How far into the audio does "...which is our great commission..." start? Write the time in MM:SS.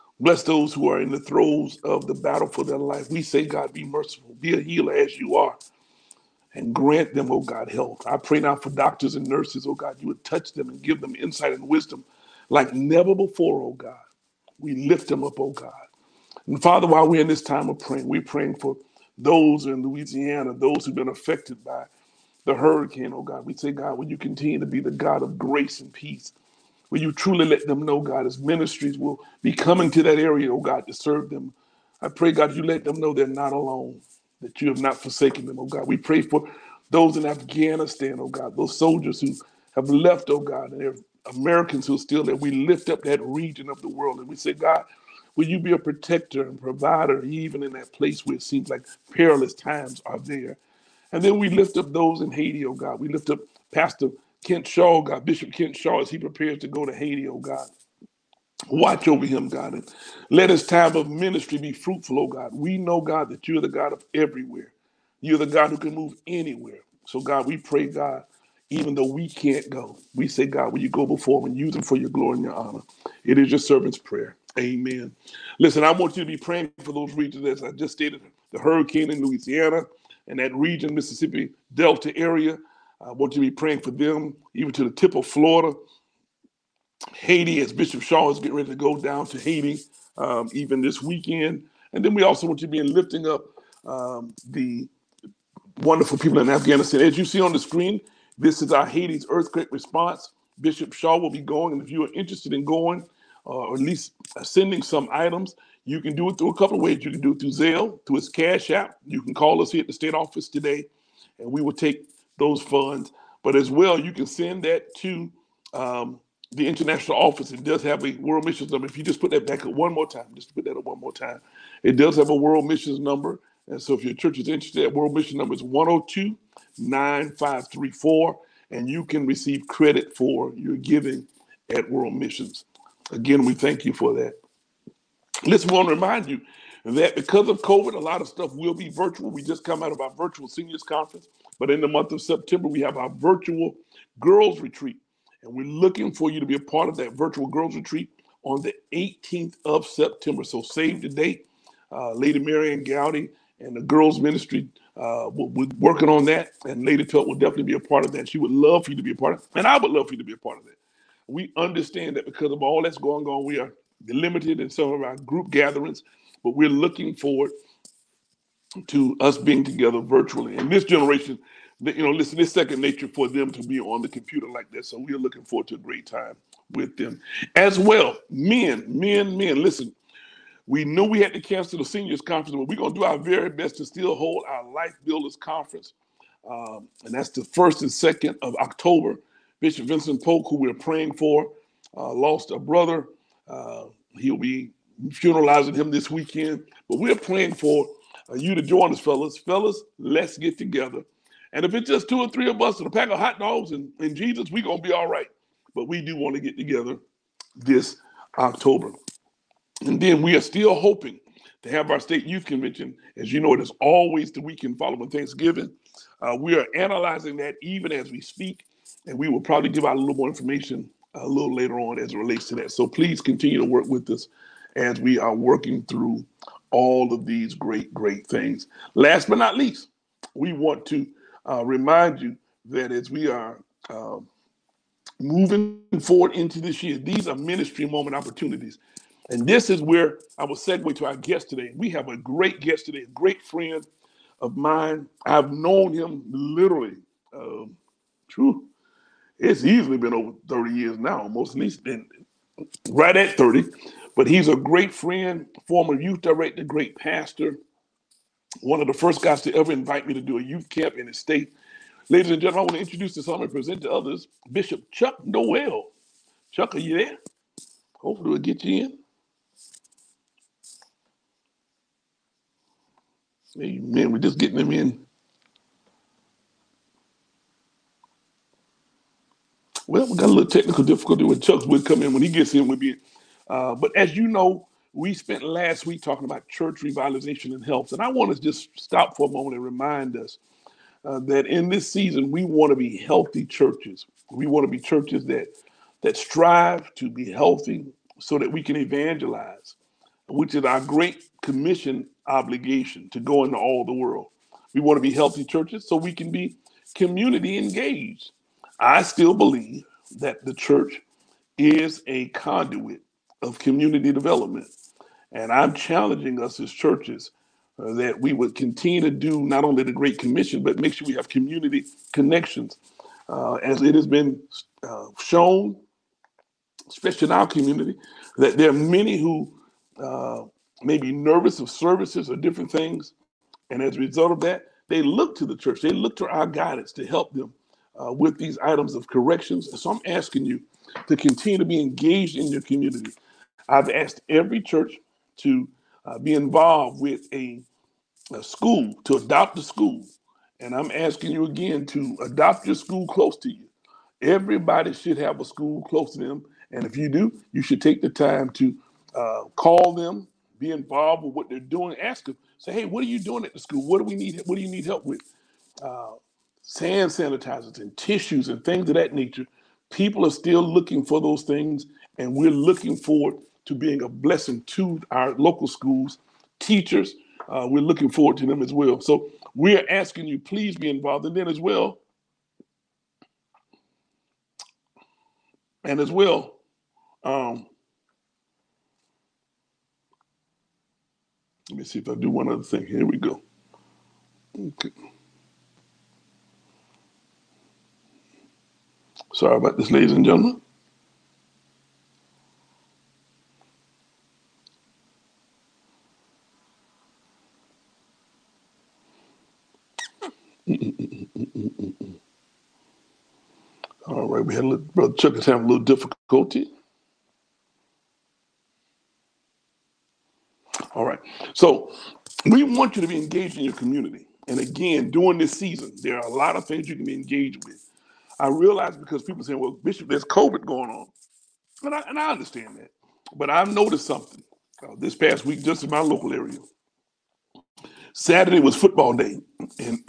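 05:00.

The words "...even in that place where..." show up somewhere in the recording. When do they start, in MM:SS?
00:47.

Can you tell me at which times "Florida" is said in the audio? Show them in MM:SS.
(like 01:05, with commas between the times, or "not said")
01:25.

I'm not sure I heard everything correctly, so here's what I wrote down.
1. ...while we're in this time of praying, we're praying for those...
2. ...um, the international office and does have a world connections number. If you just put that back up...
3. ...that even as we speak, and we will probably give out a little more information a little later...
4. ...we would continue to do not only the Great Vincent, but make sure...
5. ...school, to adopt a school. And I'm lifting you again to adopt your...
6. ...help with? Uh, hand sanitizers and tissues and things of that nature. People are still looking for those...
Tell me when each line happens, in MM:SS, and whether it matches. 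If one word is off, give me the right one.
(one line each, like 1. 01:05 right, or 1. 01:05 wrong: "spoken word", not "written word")
1. 00:16 right
2. 01:55 wrong: "missions", not "connections"
3. 03:37 right
4. 05:18 wrong: "Commission", not "Vincent"
5. 05:48 wrong: "asking", not "lifting"
6. 06:04 right.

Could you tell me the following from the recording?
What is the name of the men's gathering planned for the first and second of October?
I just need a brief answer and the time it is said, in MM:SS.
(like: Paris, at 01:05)
Life Builders Conference, at 03:04.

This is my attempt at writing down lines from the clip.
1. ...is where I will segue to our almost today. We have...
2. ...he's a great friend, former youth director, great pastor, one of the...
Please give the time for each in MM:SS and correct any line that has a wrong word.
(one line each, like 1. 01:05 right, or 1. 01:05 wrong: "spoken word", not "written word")
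1. 03:59 wrong: "guest", not "almost"
2. 04:14 right.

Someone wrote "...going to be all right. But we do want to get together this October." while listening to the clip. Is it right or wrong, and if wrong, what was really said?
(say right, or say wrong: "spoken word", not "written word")
right.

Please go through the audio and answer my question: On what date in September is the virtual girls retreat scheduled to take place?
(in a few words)
18th of September.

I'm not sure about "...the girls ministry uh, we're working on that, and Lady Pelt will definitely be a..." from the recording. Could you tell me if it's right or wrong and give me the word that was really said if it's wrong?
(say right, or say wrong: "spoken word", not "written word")
right.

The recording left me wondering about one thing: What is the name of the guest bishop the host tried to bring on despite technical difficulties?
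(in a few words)
Chuck Noel.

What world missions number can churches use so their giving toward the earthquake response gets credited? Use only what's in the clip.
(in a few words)
102 9534.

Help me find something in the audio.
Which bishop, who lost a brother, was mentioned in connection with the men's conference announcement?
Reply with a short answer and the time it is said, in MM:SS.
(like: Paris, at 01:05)
Vincent Polk, at 03:09.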